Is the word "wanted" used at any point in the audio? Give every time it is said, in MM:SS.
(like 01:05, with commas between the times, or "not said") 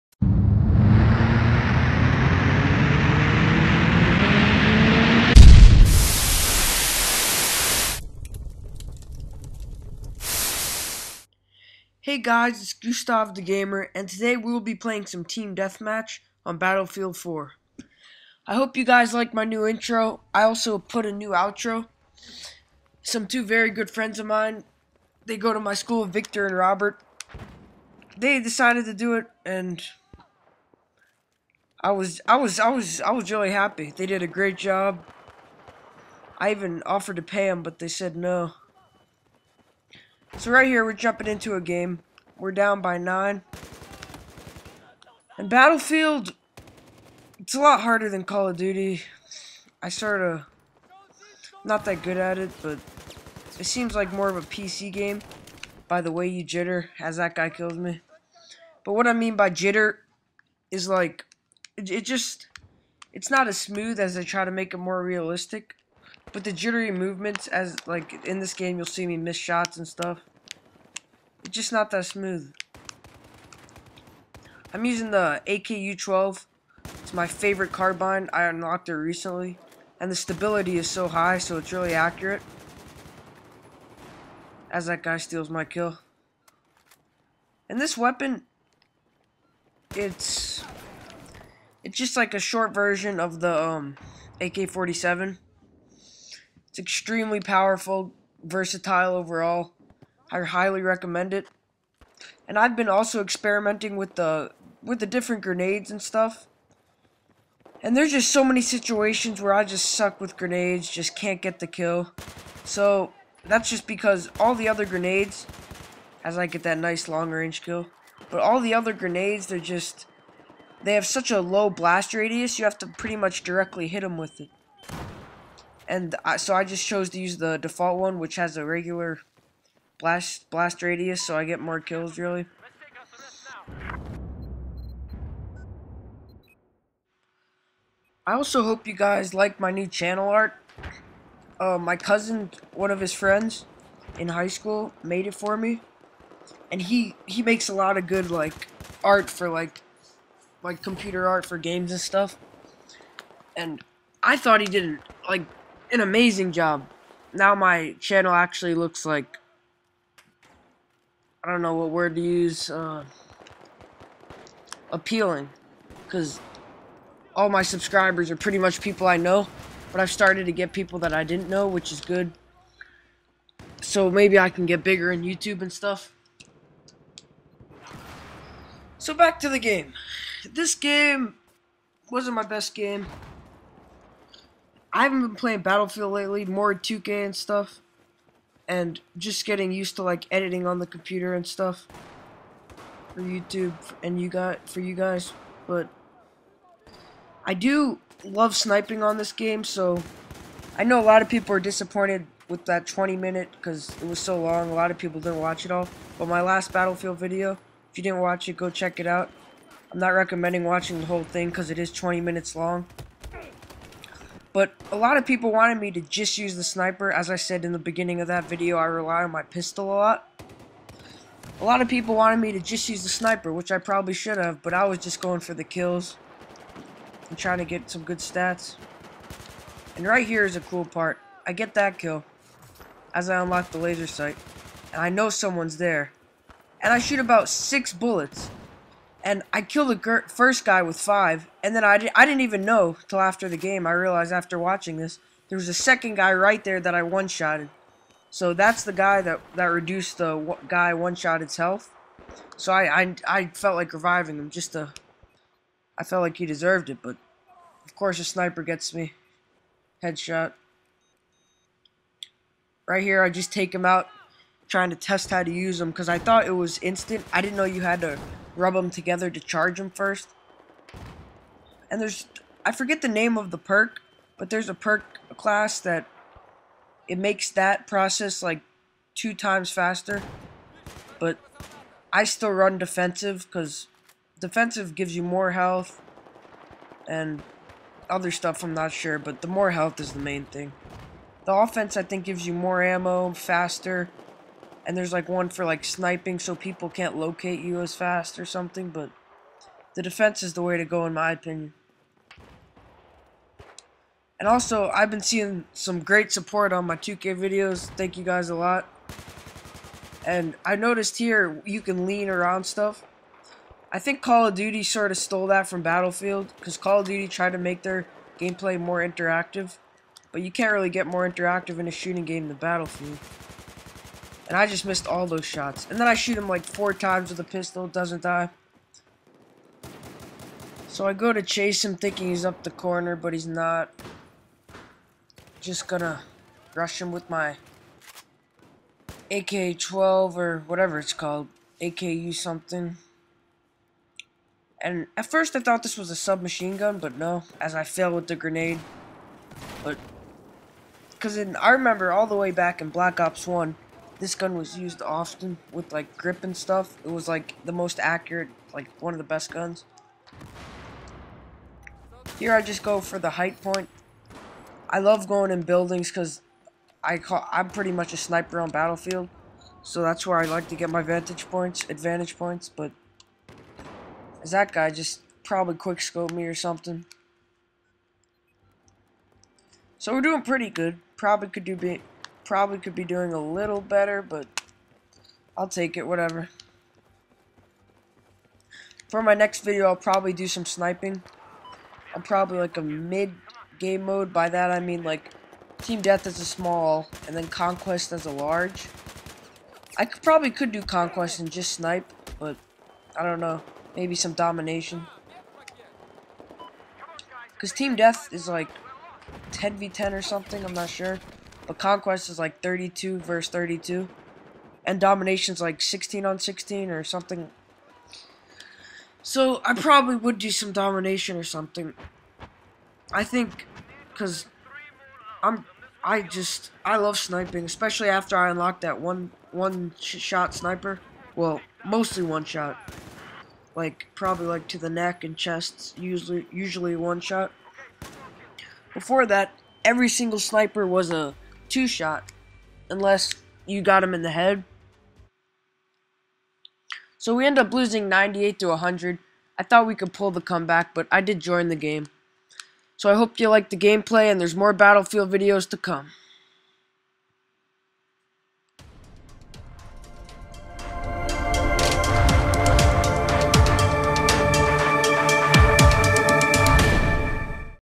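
03:35, 03:42.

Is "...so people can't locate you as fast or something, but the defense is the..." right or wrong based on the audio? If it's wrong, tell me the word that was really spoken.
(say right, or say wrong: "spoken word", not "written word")
right.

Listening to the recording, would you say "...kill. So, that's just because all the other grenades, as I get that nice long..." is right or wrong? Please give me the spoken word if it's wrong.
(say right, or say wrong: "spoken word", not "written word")
right.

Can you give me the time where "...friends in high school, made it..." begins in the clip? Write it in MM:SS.
02:23.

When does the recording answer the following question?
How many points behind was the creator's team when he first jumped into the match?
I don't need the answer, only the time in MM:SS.
00:42.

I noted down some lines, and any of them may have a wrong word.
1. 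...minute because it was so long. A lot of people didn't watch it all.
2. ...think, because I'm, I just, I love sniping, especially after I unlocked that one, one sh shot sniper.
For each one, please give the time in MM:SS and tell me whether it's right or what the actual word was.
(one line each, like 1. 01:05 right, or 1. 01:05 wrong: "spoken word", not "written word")
1. 03:23 right
2. 07:03 right.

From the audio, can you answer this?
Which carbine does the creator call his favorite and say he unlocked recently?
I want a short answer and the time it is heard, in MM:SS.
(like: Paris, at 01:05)
AKU-12, at 01:15.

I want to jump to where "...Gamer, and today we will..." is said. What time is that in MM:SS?
00:13.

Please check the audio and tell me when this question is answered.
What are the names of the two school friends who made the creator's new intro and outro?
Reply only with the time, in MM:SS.
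00:26.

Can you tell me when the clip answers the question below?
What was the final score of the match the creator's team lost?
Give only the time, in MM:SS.
07:28.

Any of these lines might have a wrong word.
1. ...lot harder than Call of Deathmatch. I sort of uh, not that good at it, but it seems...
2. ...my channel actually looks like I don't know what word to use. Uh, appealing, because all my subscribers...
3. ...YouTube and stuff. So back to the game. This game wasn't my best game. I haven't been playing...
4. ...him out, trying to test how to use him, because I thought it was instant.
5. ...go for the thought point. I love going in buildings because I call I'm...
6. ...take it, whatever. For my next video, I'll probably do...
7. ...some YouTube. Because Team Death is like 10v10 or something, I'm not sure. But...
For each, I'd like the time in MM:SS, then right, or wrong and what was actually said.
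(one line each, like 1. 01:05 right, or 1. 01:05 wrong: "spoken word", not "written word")
1. 00:47 wrong: "Duty", not "Deathmatch"
2. 02:37 right
3. 02:55 right
4. 04:23 right
5. 06:02 wrong: "height", not "thought"
6. 06:25 right
7. 06:44 wrong: "Domination", not "YouTube".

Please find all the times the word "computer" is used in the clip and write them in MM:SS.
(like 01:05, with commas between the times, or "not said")
02:30, 03:10.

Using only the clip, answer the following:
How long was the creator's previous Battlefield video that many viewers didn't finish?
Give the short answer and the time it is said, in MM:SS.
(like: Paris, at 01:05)
20 minutes, at 03:31.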